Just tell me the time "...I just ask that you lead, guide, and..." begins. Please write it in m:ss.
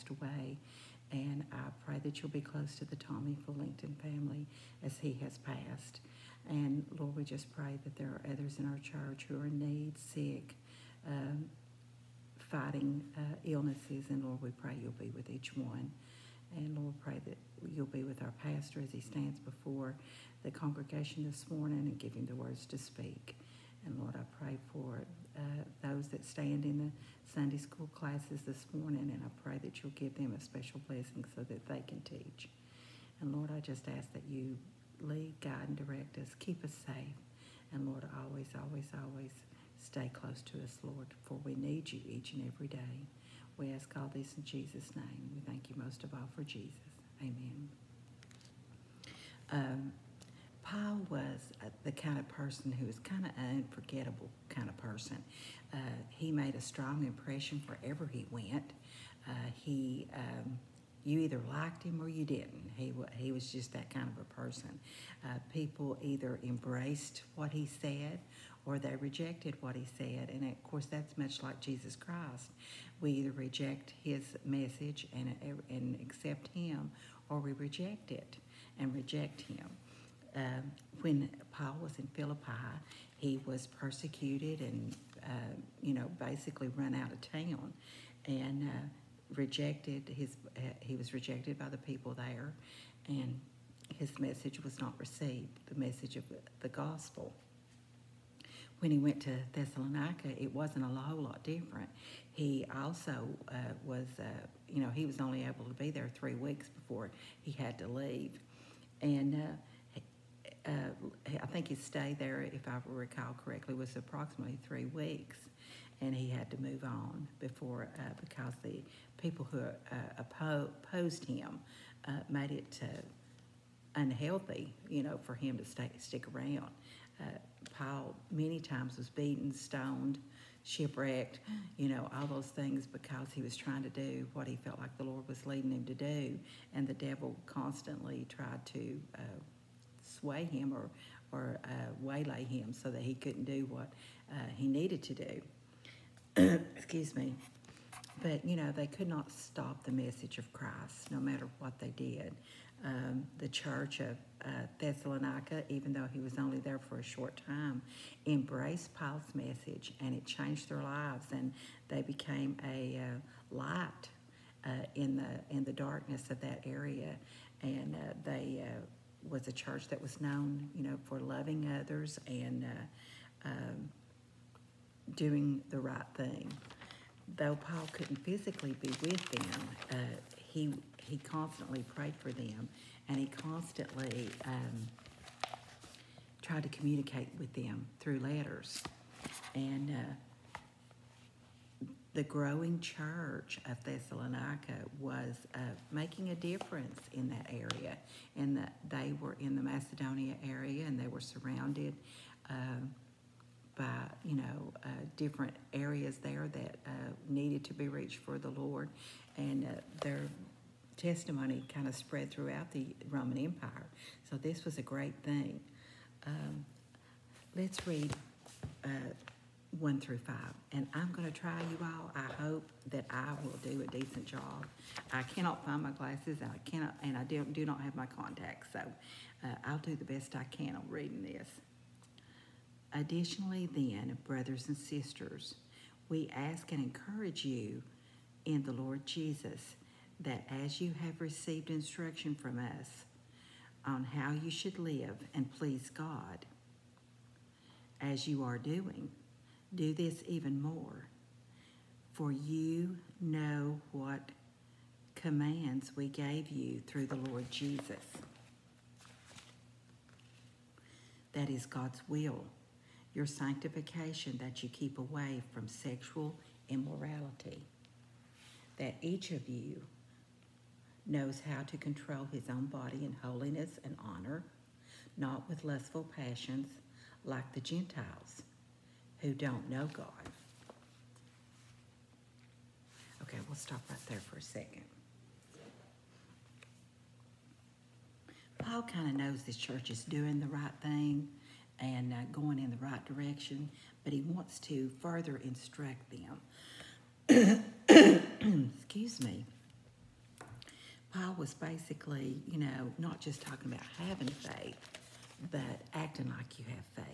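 0:33.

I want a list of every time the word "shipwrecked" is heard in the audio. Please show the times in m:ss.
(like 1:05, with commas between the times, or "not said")
2:10.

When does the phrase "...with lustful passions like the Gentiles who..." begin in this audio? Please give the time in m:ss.
4:35.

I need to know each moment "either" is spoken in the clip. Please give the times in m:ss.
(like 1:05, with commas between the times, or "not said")
1:01, 1:06, 1:13.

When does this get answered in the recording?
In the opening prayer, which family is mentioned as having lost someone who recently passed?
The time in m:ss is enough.
0:02.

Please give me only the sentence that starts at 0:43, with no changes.
We ask all this in Jesus' name.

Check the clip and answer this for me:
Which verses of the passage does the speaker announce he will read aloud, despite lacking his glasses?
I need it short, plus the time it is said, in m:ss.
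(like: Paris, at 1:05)
1 through 5, at 3:39.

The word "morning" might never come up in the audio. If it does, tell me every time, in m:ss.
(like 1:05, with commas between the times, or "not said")
0:21, 0:28.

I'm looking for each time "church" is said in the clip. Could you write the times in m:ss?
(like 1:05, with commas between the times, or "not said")
0:08, 2:33, 2:49, 3:12, 4:49.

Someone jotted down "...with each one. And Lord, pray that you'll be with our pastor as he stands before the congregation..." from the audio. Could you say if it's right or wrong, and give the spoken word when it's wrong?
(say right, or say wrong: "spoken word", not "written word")
right.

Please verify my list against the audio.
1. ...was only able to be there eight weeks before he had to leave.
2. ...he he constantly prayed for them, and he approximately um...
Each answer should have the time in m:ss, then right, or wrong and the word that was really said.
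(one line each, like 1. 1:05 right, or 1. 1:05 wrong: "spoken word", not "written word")
1. 1:45 wrong: "three", not "eight"
2. 3:00 wrong: "constantly", not "approximately".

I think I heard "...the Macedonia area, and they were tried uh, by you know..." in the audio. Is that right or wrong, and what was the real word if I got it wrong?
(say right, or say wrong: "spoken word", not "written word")
wrong: "surrounded", not "tried".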